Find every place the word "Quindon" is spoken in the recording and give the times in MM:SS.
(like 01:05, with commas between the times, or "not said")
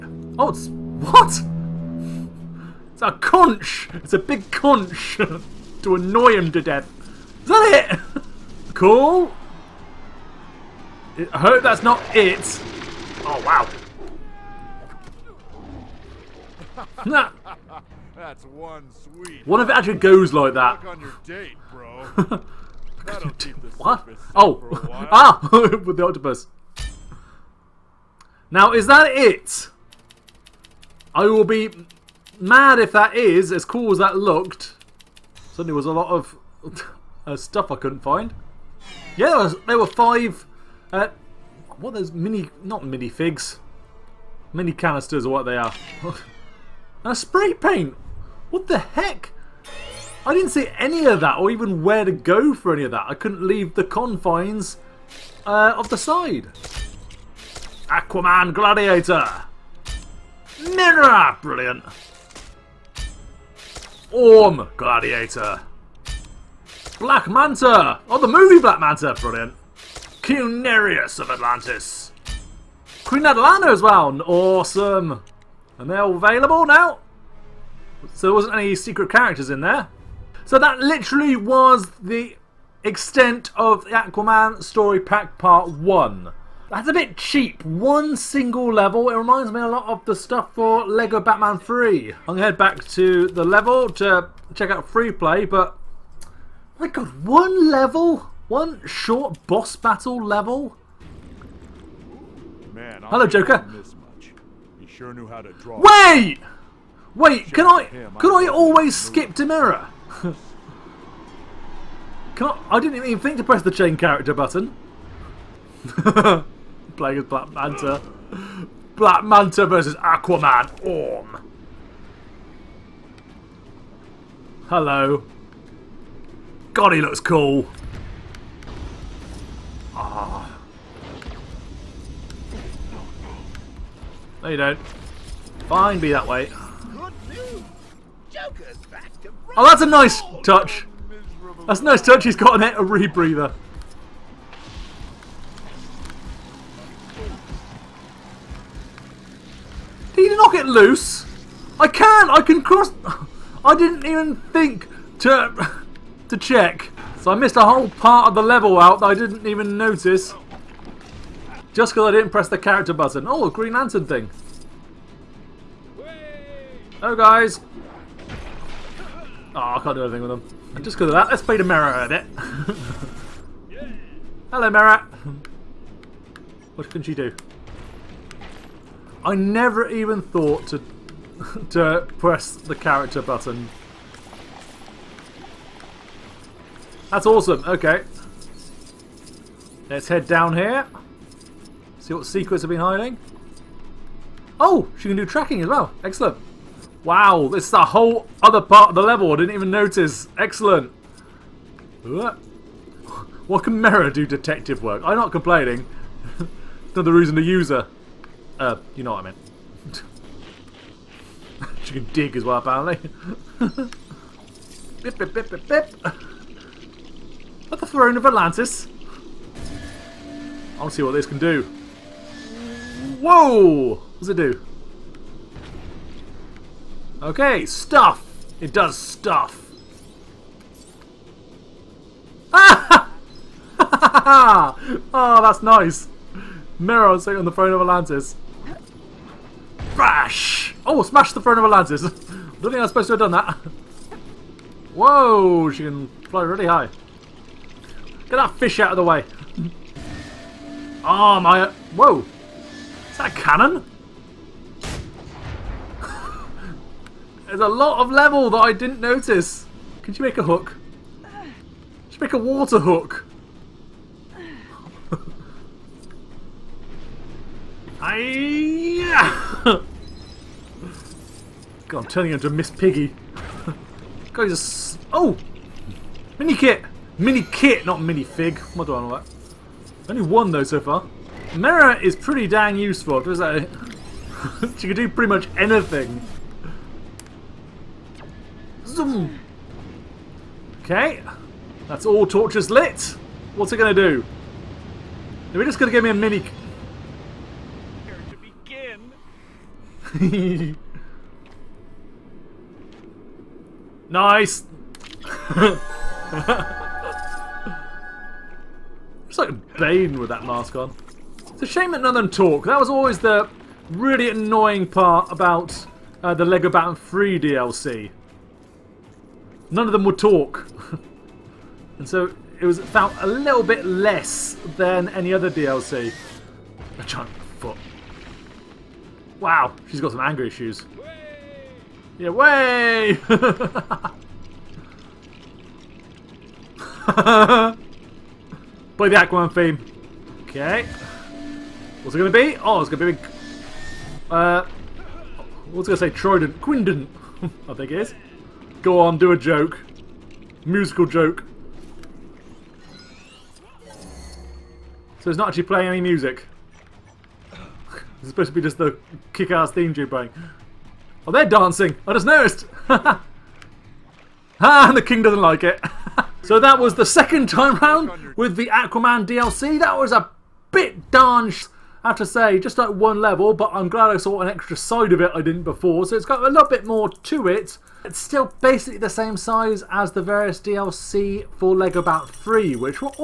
05:46.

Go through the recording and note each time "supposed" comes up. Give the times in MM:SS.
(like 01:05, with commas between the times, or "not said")
04:02, 05:58.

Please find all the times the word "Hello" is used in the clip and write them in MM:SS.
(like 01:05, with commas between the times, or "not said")
01:43, 02:04, 02:46, 02:54.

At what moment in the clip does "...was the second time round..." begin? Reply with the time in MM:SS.
06:06.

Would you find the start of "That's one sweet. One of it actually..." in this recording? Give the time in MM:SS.
00:18.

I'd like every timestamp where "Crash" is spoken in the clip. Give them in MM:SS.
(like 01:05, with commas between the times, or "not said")
03:59.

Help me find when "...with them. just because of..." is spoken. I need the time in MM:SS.
02:50.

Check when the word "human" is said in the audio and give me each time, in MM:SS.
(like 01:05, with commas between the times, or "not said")
not said.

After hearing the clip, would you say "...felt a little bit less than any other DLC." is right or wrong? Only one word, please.
right.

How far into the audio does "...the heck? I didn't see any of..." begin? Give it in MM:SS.
00:48.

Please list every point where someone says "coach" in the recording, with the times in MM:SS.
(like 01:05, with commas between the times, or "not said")
not said.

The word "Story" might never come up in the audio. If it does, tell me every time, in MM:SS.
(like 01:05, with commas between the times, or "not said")
01:24.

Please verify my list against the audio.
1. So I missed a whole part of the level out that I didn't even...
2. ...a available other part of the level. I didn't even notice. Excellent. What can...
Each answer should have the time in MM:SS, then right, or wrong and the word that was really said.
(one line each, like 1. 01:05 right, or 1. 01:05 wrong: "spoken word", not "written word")
1. 02:37 right
2. 03:17 wrong: "whole", not "available".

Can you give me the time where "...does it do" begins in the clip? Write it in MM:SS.
03:44.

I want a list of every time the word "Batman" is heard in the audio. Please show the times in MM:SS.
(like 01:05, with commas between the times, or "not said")
01:31, 05:16.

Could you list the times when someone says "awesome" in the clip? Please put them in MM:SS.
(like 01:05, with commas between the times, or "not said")
01:14, 03:07.